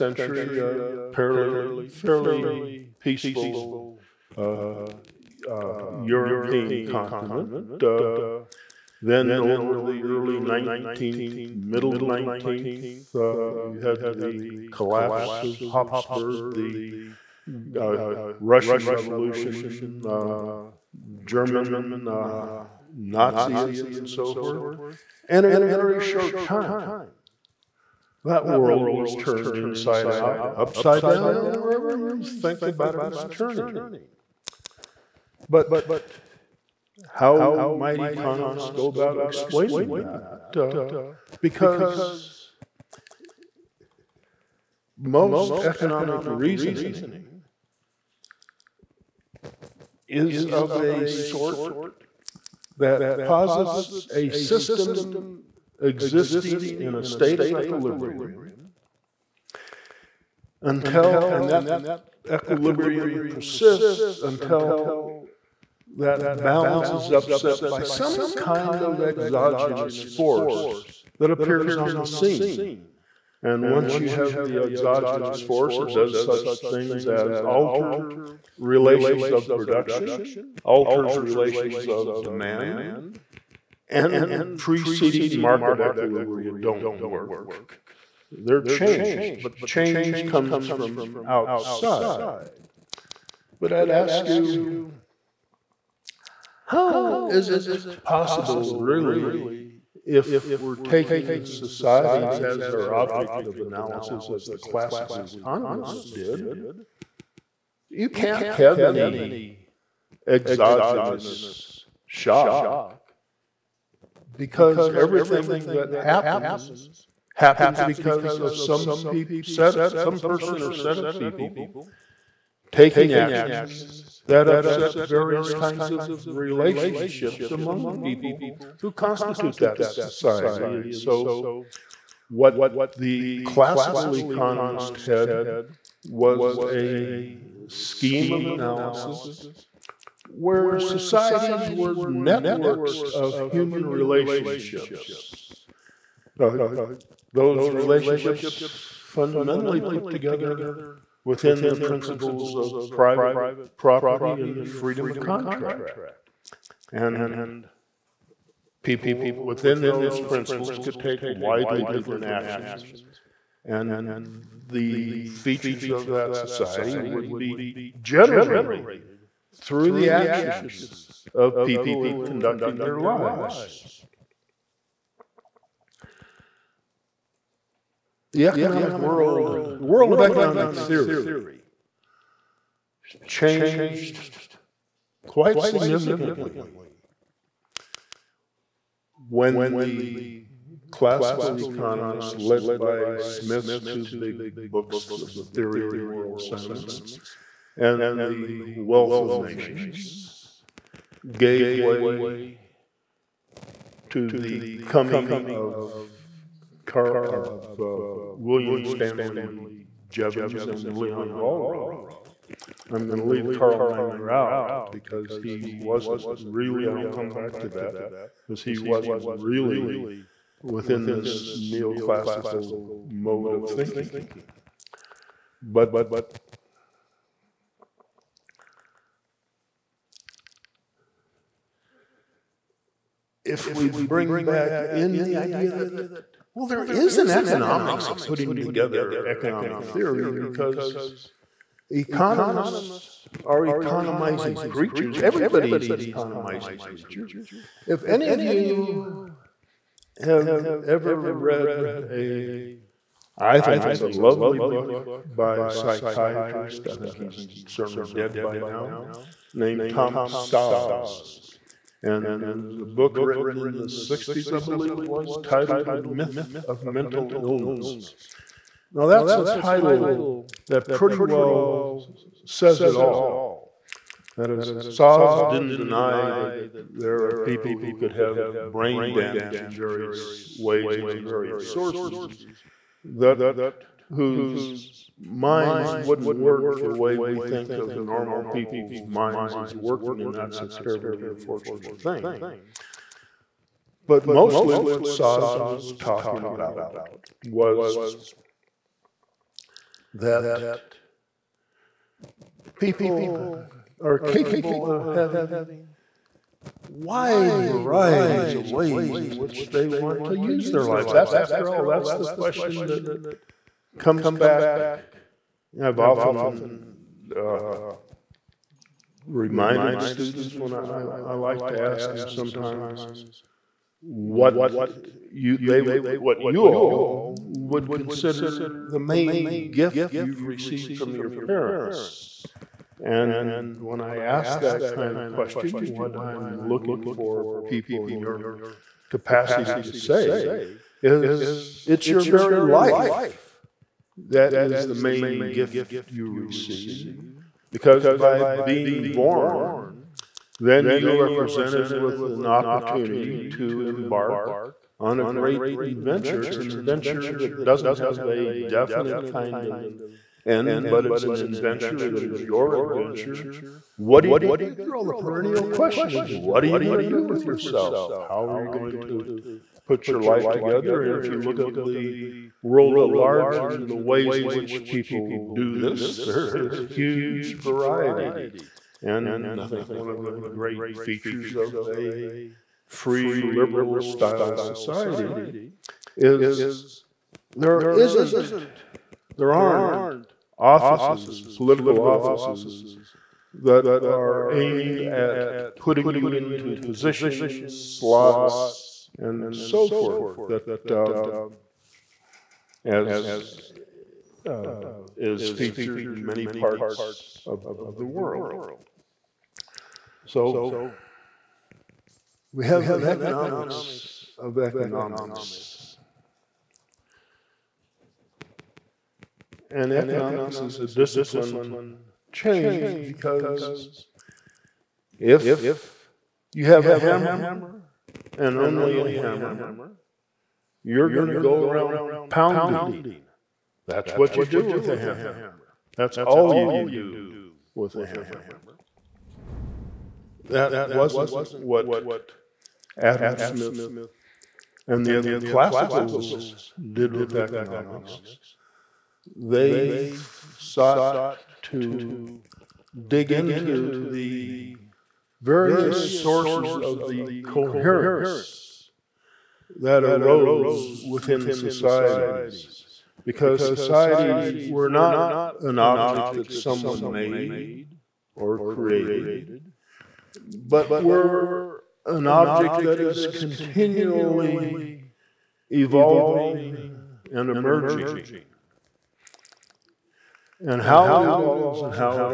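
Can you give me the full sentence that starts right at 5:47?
Because by being born, then you are presented with an opportunity to embark on a great adventure.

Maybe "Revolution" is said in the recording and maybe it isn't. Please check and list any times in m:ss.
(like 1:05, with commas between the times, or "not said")
0:18.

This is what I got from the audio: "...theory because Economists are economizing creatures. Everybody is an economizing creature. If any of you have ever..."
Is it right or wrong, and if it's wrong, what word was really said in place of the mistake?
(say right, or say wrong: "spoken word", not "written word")
right.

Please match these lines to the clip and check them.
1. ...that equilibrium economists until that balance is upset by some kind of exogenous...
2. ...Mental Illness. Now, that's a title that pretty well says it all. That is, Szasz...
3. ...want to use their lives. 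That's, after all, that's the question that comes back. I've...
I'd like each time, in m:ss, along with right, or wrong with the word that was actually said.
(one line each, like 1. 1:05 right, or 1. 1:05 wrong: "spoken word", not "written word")
1. 1:01 wrong: "persists", not "economists"
2. 4:26 right
3. 5:09 right.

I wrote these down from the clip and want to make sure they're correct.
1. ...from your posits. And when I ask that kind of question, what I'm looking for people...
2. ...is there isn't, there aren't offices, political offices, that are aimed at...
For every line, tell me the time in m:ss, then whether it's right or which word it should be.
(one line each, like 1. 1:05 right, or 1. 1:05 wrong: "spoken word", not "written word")
1. 5:30 wrong: "parents", not "posits"
2. 6:26 right.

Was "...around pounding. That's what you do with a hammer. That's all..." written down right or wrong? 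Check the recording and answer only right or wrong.
right.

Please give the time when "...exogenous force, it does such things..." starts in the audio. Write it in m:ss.
1:14.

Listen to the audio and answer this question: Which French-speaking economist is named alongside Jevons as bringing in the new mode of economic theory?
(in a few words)
Leon Walras.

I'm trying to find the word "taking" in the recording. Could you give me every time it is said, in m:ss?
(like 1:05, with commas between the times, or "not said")
1:40, 2:02.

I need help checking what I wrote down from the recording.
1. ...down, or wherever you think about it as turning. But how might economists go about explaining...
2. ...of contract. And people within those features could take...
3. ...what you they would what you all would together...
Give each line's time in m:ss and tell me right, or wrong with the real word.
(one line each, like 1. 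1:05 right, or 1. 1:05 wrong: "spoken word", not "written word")
1. 0:31 right
2. 2:35 wrong: "principles", not "features"
3. 5:24 wrong: "consider", not "together".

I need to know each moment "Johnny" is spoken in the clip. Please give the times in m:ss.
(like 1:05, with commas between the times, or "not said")
not said.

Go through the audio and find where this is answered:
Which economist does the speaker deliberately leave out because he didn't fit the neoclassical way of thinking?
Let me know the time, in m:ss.
3:33.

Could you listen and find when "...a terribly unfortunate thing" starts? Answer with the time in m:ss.
4:50.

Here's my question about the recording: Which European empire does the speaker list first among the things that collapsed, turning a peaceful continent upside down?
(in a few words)
Habsburg.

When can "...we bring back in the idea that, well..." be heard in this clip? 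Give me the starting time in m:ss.
3:53.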